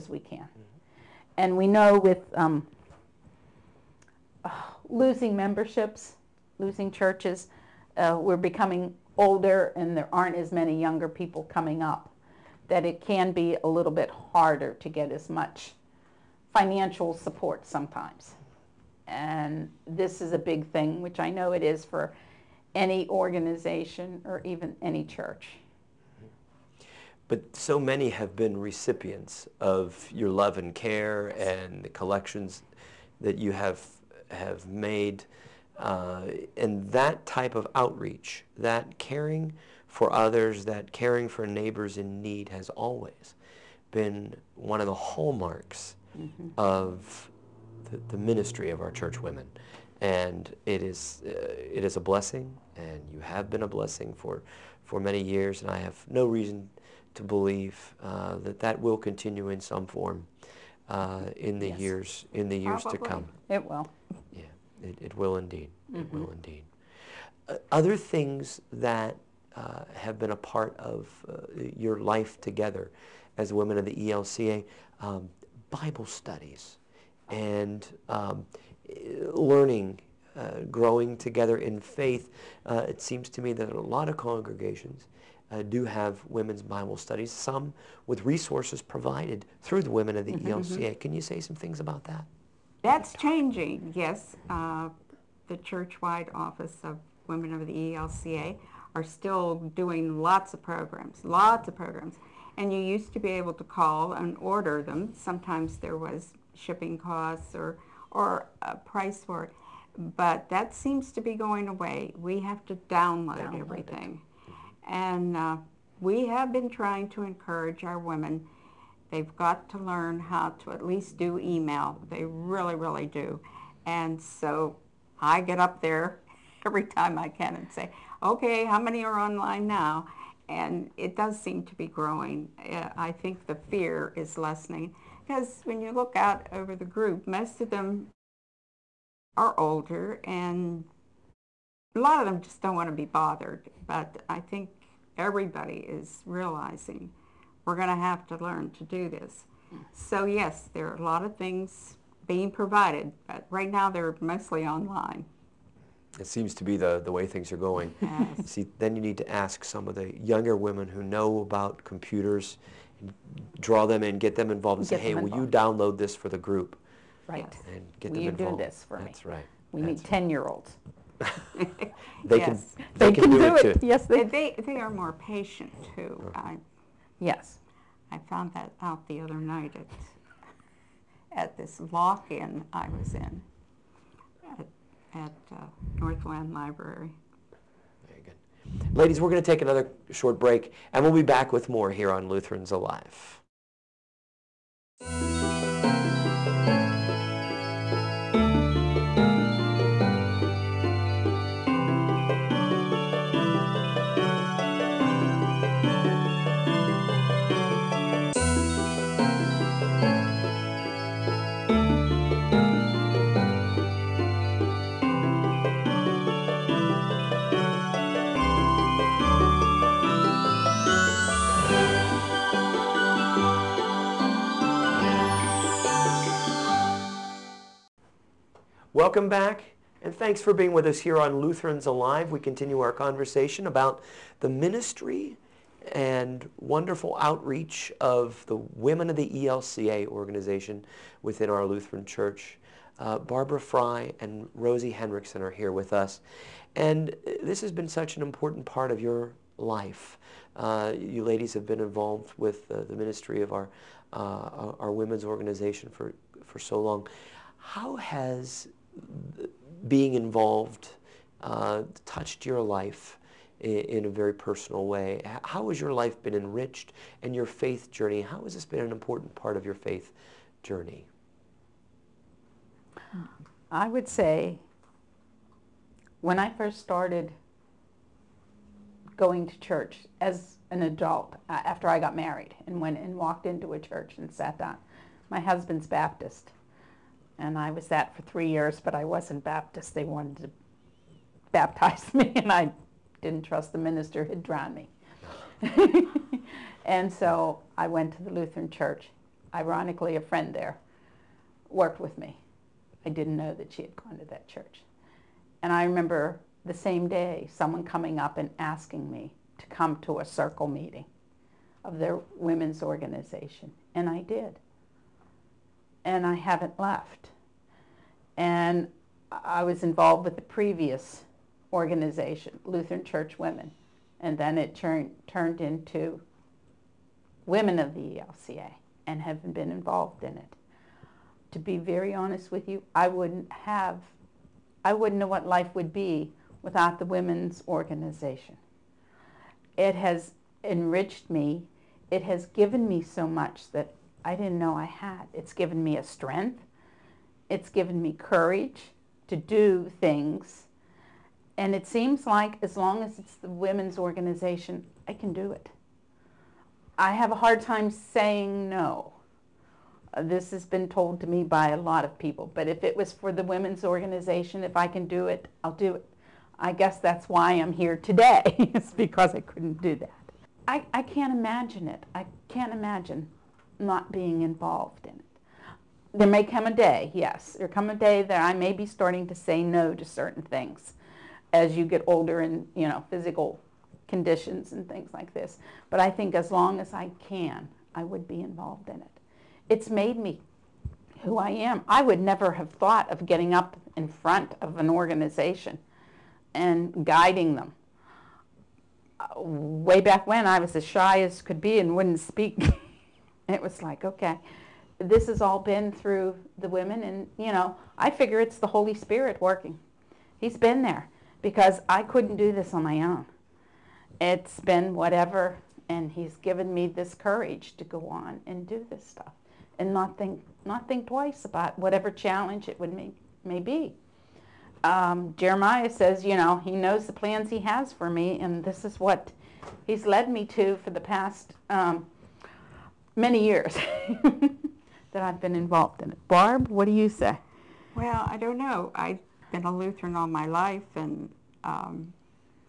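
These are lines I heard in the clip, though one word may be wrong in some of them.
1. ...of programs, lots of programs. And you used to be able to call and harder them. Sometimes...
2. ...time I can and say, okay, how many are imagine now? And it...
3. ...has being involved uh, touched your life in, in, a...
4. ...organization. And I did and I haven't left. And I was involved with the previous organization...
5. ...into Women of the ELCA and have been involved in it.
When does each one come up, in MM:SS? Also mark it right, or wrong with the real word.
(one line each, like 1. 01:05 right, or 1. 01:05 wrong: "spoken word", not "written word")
1. 01:40 wrong: "order", not "harder"
2. 02:06 wrong: "online", not "imagine"
3. 04:17 right
4. 05:12 right
5. 05:25 right.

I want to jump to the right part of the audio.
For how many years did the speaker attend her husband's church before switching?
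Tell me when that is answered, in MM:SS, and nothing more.
04:48.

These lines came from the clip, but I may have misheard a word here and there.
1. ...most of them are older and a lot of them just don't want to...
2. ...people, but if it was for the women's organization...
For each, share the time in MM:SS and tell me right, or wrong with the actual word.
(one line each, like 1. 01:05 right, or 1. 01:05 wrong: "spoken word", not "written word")
1. 02:17 right
2. 06:02 right.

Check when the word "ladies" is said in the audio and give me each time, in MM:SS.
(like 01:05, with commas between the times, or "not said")
03:08, 04:11.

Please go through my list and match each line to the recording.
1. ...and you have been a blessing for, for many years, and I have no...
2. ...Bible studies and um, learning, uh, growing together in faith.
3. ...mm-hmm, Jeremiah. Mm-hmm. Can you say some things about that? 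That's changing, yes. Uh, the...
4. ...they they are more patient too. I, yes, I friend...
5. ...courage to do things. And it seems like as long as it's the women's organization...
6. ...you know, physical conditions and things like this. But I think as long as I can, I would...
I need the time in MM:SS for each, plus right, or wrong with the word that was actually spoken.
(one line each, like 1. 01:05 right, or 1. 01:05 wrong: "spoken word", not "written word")
1. 00:52 right
2. 01:15 right
3. 01:30 wrong: "ELCA", not "Jeremiah"
4. 02:54 wrong: "found", not "friend"
5. 05:48 right
6. 06:22 right.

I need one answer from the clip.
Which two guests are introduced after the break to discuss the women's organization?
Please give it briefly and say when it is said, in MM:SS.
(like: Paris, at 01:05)
Barbara Fry and Rosie Hendrickson, at 04:03.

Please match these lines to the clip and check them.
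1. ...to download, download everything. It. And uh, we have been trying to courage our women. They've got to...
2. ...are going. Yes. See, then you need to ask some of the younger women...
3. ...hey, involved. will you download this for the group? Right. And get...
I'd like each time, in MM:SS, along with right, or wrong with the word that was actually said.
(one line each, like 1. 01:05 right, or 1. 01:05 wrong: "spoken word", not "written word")
1. 01:52 wrong: "encourage", not "courage"
2. 02:37 right
3. 02:45 right.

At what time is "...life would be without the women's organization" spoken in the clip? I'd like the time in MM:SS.
05:35.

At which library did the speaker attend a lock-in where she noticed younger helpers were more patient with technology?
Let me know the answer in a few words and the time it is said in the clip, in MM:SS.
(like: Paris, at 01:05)
Northland Library, at 03:05.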